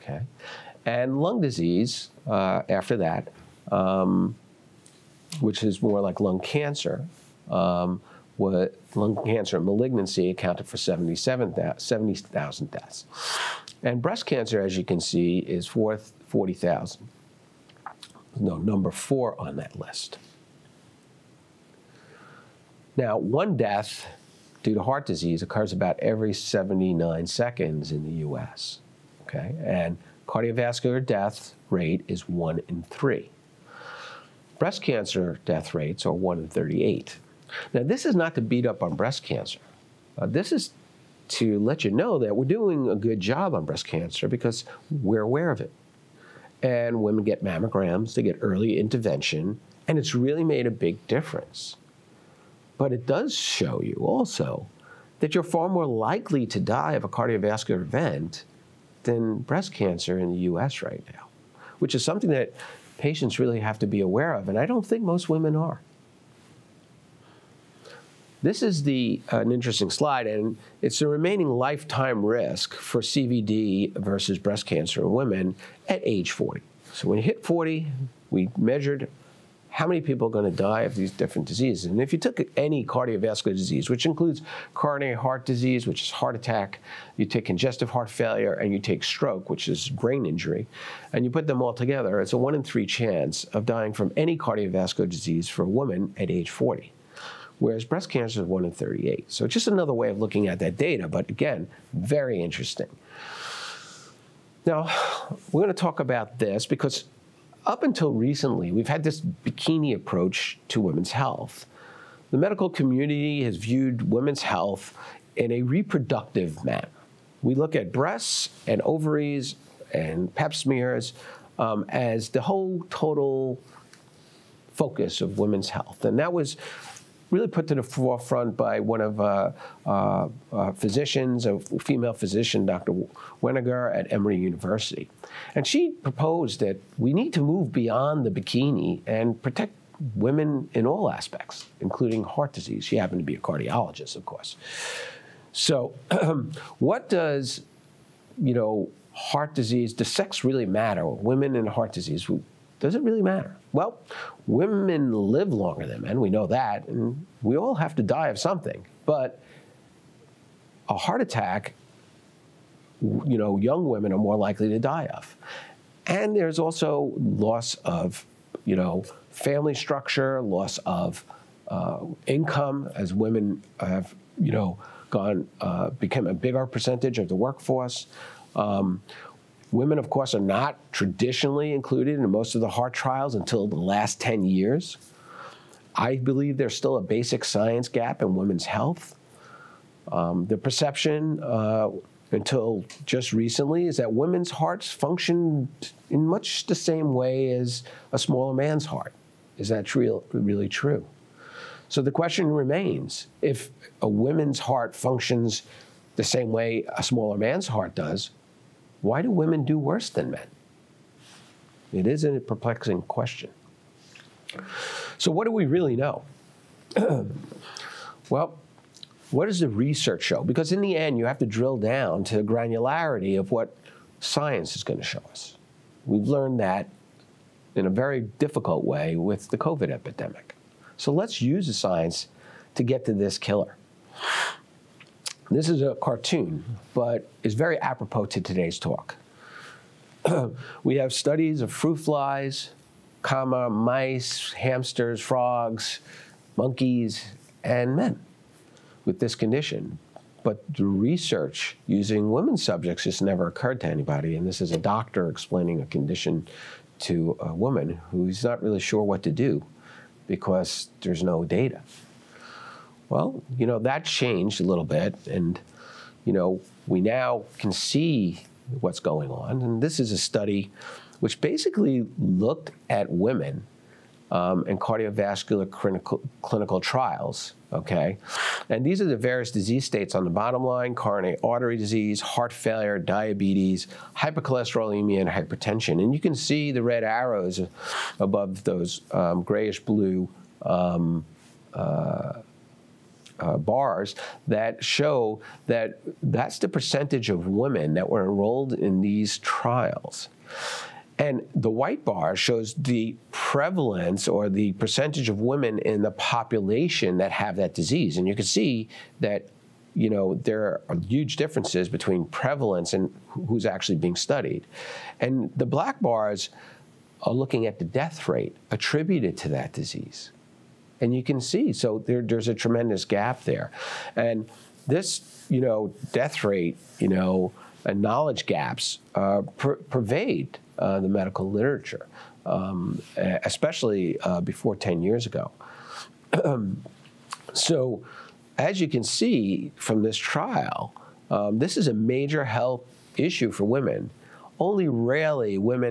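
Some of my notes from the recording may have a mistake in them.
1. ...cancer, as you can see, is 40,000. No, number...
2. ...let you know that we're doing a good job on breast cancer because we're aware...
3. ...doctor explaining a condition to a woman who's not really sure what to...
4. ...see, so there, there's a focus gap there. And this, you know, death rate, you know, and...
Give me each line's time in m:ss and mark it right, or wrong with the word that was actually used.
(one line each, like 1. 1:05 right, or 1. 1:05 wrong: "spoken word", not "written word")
1. 0:14 right
2. 0:41 right
3. 4:14 right
4. 5:21 wrong: "tremendous", not "focus".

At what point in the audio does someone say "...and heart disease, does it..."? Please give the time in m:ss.
2:31.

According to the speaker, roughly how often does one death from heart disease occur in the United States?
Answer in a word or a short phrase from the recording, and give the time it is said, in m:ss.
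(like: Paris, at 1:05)
every 79 seconds, at 0:26.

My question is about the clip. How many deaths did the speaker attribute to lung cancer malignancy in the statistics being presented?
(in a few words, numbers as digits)
77,000.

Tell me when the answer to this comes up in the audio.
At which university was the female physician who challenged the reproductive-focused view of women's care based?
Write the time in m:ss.
2:14.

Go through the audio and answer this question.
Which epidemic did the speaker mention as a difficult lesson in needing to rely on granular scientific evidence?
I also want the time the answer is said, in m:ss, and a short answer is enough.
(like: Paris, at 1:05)
COVID, at 3:49.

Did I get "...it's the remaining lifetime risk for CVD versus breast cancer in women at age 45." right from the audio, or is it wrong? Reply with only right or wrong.
wrong.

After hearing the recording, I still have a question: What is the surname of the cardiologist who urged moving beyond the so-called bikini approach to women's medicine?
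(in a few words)
Wenger.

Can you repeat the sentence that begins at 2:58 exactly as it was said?
Um, Women, of course, are not traditionally included in most of the heart trials until the last 10 years.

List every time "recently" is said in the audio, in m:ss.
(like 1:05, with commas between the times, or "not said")
1:48, 3:13.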